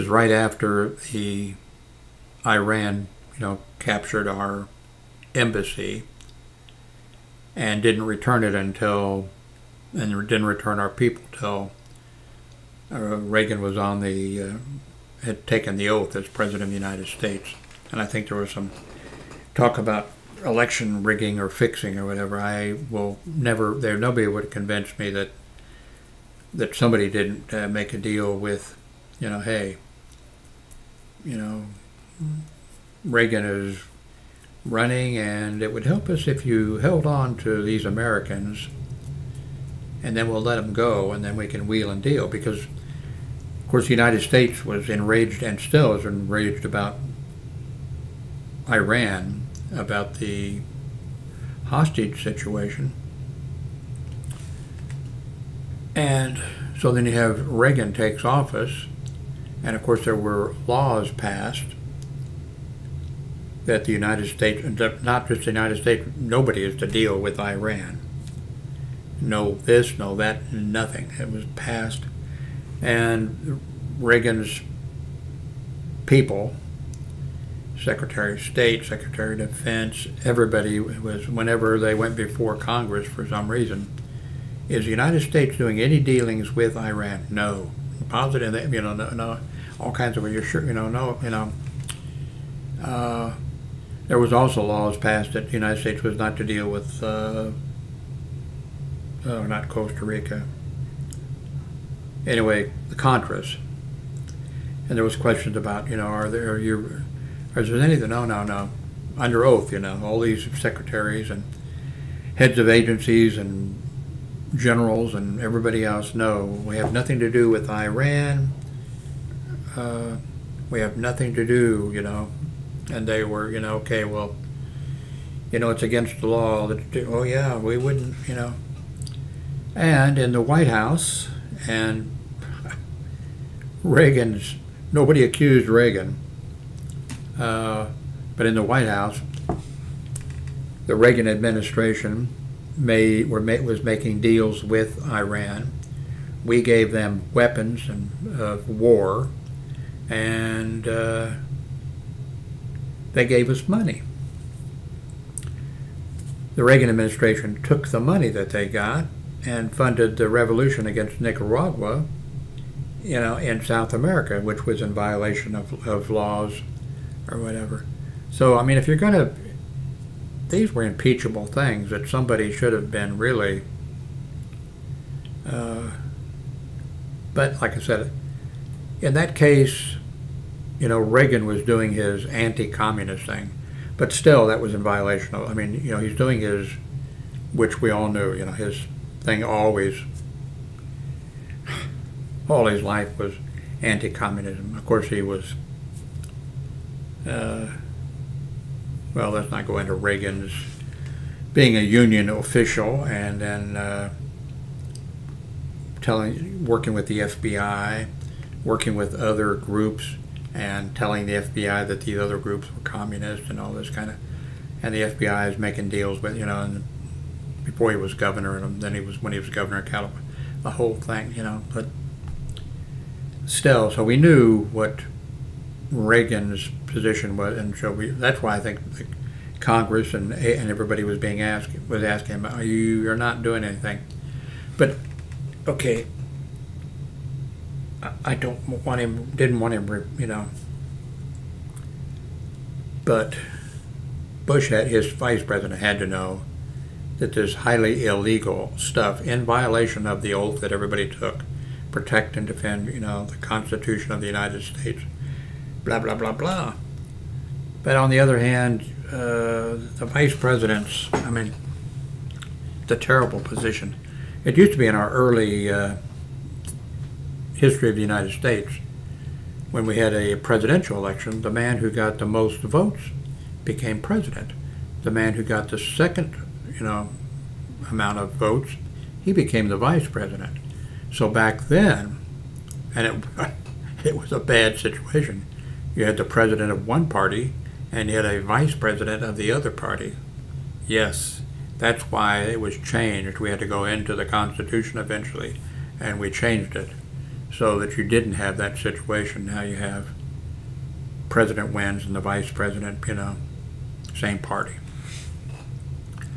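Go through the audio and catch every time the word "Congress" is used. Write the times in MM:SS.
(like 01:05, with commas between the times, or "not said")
01:22, 03:49.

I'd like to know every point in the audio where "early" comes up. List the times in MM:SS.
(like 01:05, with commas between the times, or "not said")
04:25.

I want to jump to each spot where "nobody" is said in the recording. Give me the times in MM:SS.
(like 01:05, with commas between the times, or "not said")
00:23, 01:06, 02:14.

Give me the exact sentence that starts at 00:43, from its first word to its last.
Of course, the United States was enraged and still is enraged about Iran about the hostage situation.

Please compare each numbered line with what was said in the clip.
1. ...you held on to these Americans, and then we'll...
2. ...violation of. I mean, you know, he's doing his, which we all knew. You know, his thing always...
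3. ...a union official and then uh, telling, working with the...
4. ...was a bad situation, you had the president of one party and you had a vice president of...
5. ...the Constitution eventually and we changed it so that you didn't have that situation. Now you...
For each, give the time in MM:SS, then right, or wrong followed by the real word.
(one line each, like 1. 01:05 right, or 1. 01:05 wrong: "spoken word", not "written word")
1. 00:36 right
2. 03:04 right
3. 03:21 right
4. 04:44 right
5. 04:54 right.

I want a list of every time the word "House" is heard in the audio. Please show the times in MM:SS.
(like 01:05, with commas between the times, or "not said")
02:10, 02:18.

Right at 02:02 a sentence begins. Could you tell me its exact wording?
And they were, you know, okay, well, you know, it's against the law.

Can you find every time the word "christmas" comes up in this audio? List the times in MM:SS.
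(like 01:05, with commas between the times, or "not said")
not said.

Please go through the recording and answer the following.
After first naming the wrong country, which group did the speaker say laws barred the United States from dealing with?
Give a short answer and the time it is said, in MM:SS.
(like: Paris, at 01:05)
The Contras, at 01:42.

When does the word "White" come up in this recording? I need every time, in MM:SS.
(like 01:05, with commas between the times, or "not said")
02:10, 02:18.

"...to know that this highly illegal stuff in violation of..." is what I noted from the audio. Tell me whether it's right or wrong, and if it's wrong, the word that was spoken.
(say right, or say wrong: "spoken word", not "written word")
right.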